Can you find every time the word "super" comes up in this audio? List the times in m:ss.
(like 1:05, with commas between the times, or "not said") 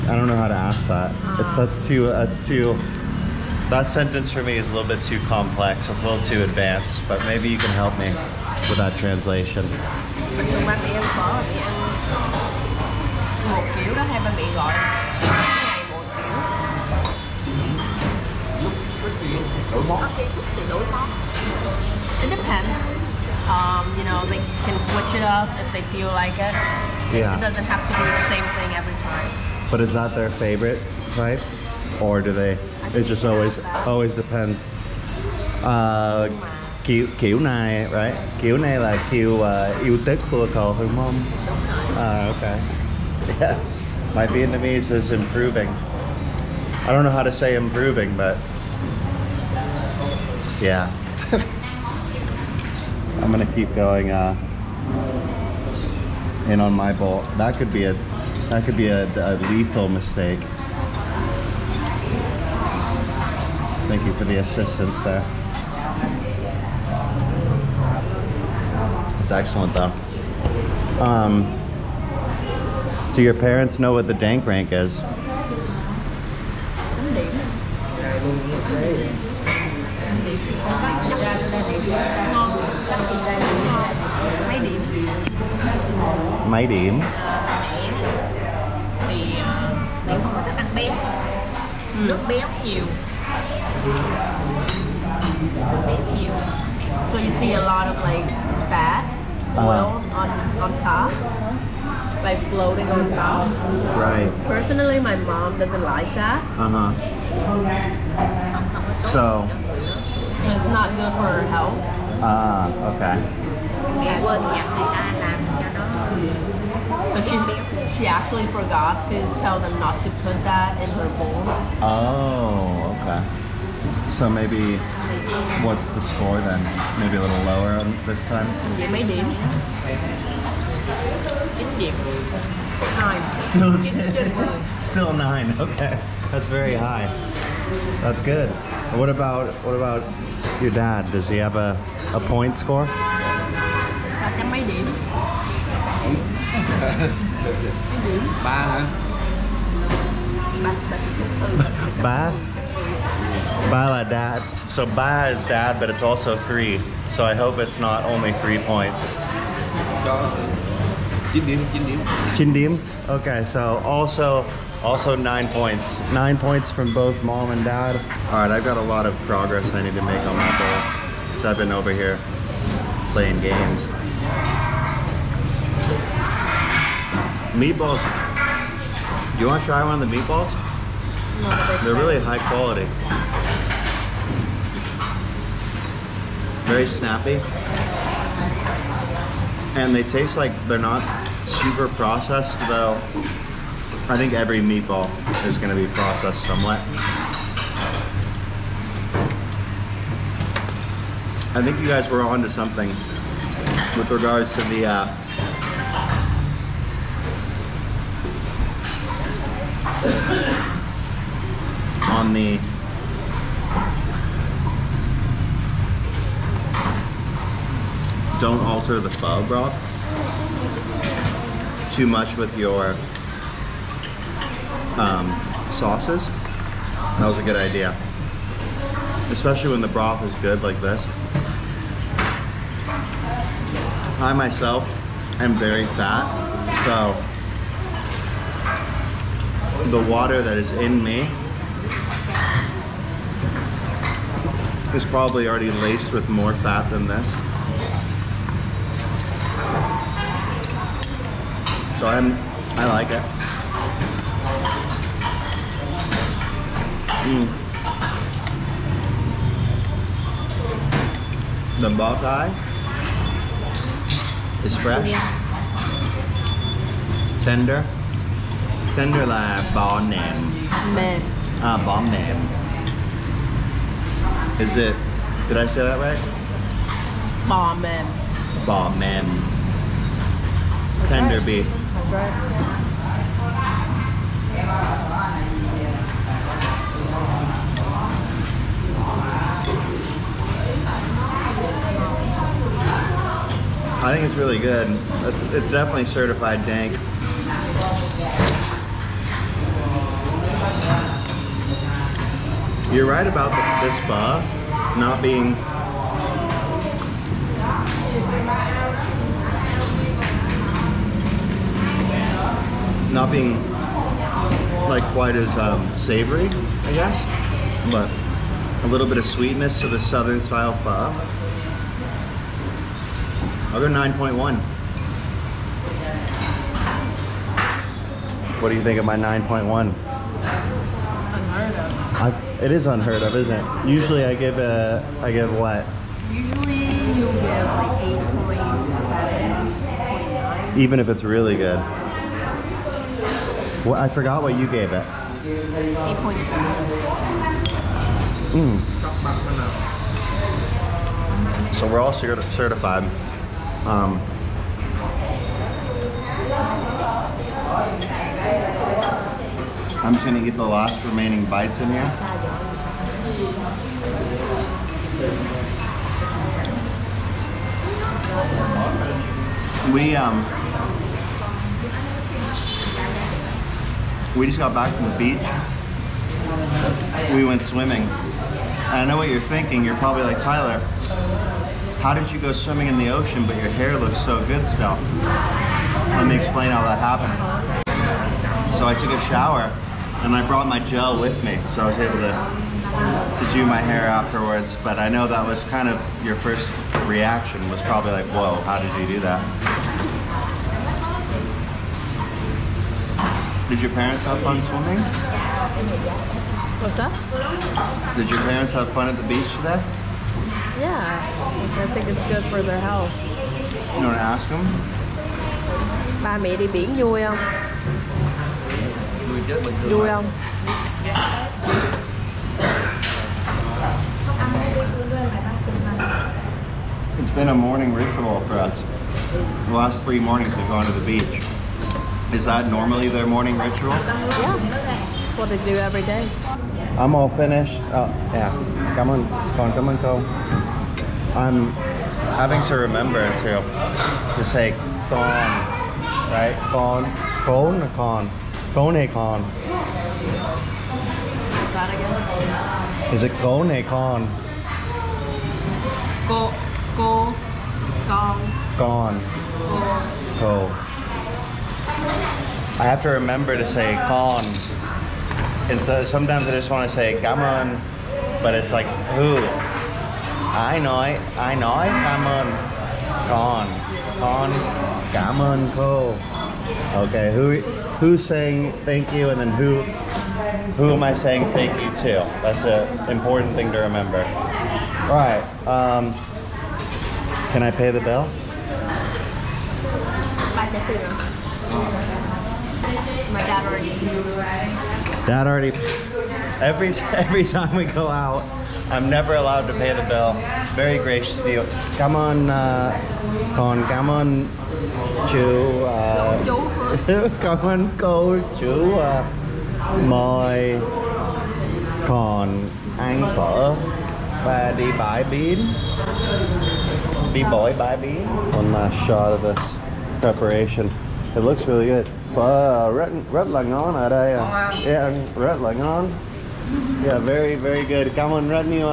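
3:11.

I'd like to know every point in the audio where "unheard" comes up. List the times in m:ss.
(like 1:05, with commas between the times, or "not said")
5:32.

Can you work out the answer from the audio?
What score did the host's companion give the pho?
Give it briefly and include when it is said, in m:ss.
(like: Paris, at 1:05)
8.6, at 5:45.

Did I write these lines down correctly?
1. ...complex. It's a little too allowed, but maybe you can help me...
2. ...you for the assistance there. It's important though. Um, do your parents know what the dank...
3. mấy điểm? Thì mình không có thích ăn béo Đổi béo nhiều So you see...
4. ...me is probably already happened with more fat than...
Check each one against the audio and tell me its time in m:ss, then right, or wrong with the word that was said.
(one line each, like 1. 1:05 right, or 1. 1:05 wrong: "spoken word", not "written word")
1. 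0:05 wrong: "advanced", not "allowed"
2. 1:04 wrong: "excellent", not "important"
3. 1:26 wrong: "Nước", not "Đổi"
4. 4:01 wrong: "laced", not "happened".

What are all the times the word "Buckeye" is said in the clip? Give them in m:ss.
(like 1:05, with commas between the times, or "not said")
4:21.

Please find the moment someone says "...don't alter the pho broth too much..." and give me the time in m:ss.
3:38.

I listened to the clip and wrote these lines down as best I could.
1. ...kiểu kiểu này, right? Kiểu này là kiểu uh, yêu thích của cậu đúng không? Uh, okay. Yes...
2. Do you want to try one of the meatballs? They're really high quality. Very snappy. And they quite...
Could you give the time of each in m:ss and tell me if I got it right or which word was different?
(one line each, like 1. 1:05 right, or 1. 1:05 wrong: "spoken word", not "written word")
1. 0:36 right
2. 2:59 wrong: "taste", not "quite".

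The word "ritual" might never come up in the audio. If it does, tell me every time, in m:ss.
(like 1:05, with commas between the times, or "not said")
7:07, 7:13.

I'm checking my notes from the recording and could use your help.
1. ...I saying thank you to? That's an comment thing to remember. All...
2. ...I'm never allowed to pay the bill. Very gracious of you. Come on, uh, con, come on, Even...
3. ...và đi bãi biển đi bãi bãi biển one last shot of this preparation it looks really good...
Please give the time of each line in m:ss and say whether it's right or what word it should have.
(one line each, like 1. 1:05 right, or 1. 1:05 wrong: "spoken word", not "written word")
1. 8:01 wrong: "important", not "comment"
2. 8:18 wrong: "Chu", not "Even"
3. 8:34 right.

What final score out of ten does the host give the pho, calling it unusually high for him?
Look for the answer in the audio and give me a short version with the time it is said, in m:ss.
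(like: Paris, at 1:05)
9.1, at 5:23.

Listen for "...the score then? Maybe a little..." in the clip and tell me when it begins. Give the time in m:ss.
2:05.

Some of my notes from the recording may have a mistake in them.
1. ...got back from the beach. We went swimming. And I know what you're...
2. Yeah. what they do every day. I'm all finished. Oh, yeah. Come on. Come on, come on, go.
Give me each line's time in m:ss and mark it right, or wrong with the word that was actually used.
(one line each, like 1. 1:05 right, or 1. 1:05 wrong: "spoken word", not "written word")
1. 6:14 right
2. 7:13 right.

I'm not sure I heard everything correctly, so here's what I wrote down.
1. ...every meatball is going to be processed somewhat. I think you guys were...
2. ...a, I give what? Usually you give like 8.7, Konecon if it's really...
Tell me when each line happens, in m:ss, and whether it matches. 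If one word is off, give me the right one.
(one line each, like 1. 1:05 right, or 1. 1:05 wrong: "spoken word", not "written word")
1. 3:14 right
2. 5:34 wrong: "Even", not "Konecon".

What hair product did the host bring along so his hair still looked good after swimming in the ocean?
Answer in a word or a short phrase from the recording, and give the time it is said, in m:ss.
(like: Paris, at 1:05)
Gel, at 6:30.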